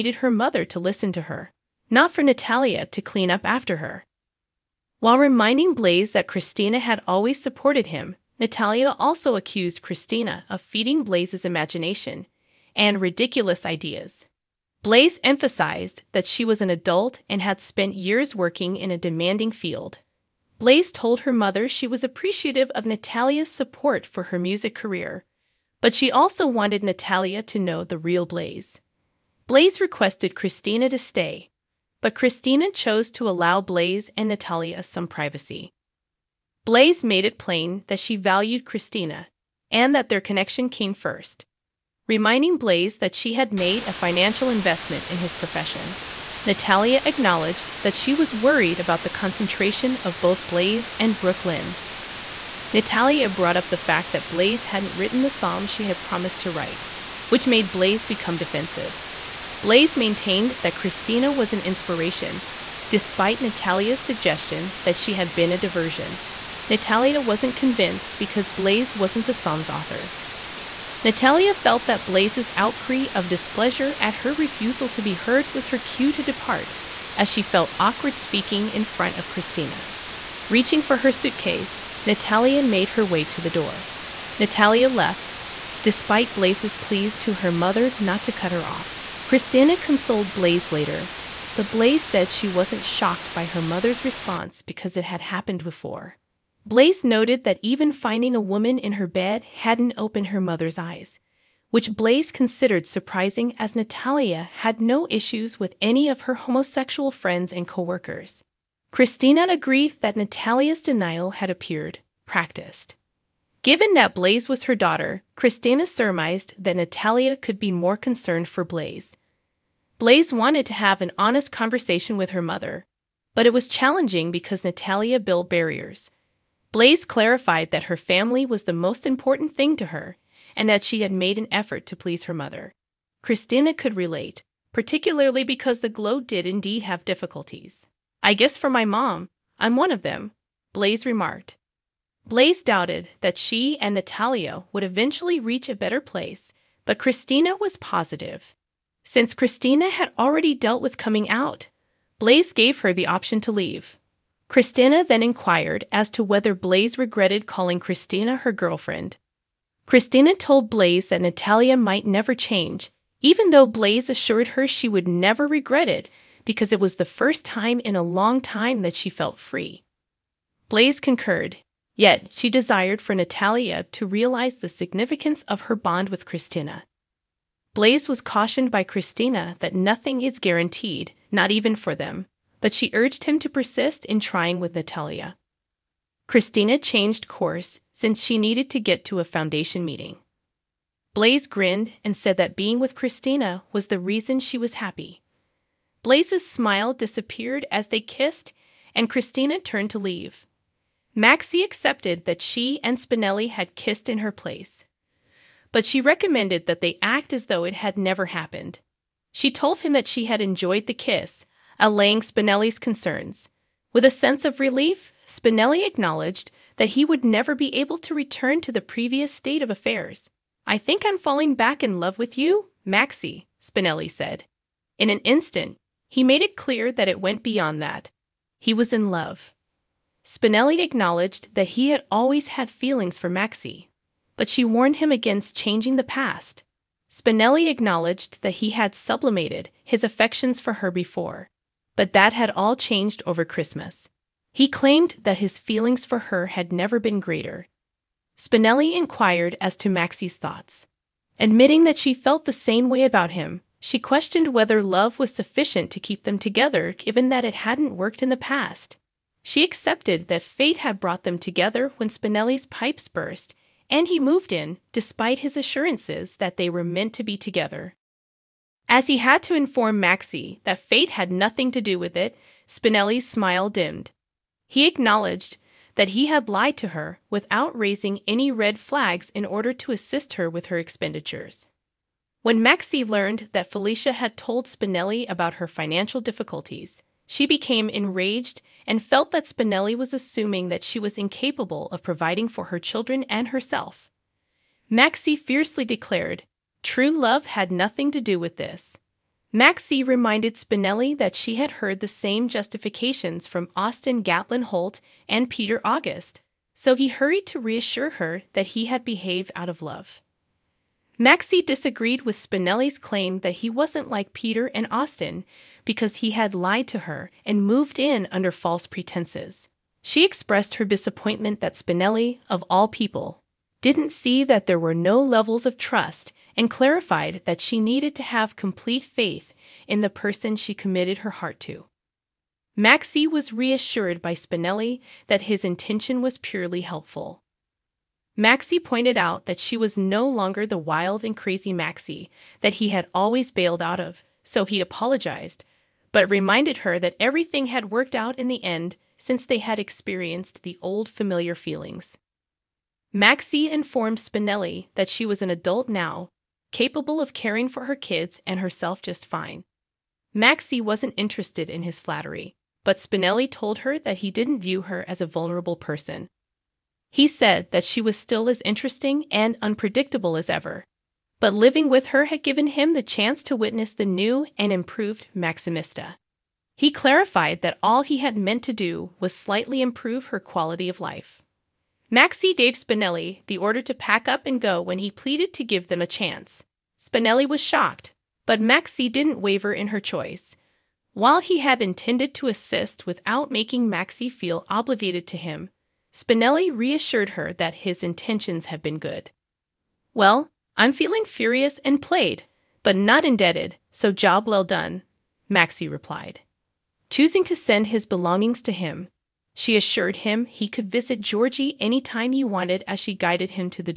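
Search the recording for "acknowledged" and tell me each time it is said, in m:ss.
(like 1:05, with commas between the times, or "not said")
0:47, 3:35, 3:50, 3:57, 4:34.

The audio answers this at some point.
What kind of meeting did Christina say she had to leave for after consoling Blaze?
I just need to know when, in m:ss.
3:09.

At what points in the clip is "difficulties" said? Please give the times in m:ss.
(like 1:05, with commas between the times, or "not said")
2:17, 4:46.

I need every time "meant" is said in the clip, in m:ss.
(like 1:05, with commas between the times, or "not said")
4:26, 6:18.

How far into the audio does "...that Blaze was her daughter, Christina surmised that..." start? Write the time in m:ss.
1:53.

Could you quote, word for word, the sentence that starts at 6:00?
Maxie wasn't interested in his flattery, but Spinelli told her that he didn't view her as a vulnerable person.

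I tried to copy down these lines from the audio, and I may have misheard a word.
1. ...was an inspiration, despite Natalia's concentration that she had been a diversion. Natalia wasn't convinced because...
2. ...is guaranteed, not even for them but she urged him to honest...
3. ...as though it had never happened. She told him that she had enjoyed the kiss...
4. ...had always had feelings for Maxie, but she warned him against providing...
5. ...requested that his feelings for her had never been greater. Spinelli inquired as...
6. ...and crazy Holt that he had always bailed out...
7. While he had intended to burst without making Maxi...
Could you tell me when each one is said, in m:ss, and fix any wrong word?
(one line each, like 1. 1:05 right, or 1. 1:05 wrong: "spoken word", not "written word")
1. 1:01 wrong: "suggestion", not "concentration"
2. 3:00 wrong: "persist", not "honest"
3. 3:27 right
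4. 3:51 wrong: "changing", not "providing"
5. 4:04 wrong: "claimed", not "requested"
6. 5:41 wrong: "Maxie", not "Holt"
7. 6:31 wrong: "assist", not "burst".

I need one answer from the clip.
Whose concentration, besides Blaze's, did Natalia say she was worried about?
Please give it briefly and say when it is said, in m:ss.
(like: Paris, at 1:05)
Brook Lynn, at 0:51.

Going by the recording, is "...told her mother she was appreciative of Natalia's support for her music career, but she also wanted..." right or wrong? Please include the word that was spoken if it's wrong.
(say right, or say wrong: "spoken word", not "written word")
right.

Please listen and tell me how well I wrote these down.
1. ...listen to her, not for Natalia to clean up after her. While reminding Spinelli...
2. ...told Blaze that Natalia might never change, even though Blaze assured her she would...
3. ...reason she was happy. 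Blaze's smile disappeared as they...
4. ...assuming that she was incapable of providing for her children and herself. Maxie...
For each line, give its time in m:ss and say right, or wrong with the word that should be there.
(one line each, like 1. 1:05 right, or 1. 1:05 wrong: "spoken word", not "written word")
1. 0:00 wrong: "Blaze", not "Spinelli"
2. 2:40 right
3. 3:13 right
4. 4:50 right.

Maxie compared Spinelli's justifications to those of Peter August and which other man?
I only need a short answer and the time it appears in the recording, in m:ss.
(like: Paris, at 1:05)
Austin Gatlin Holt, at 5:03.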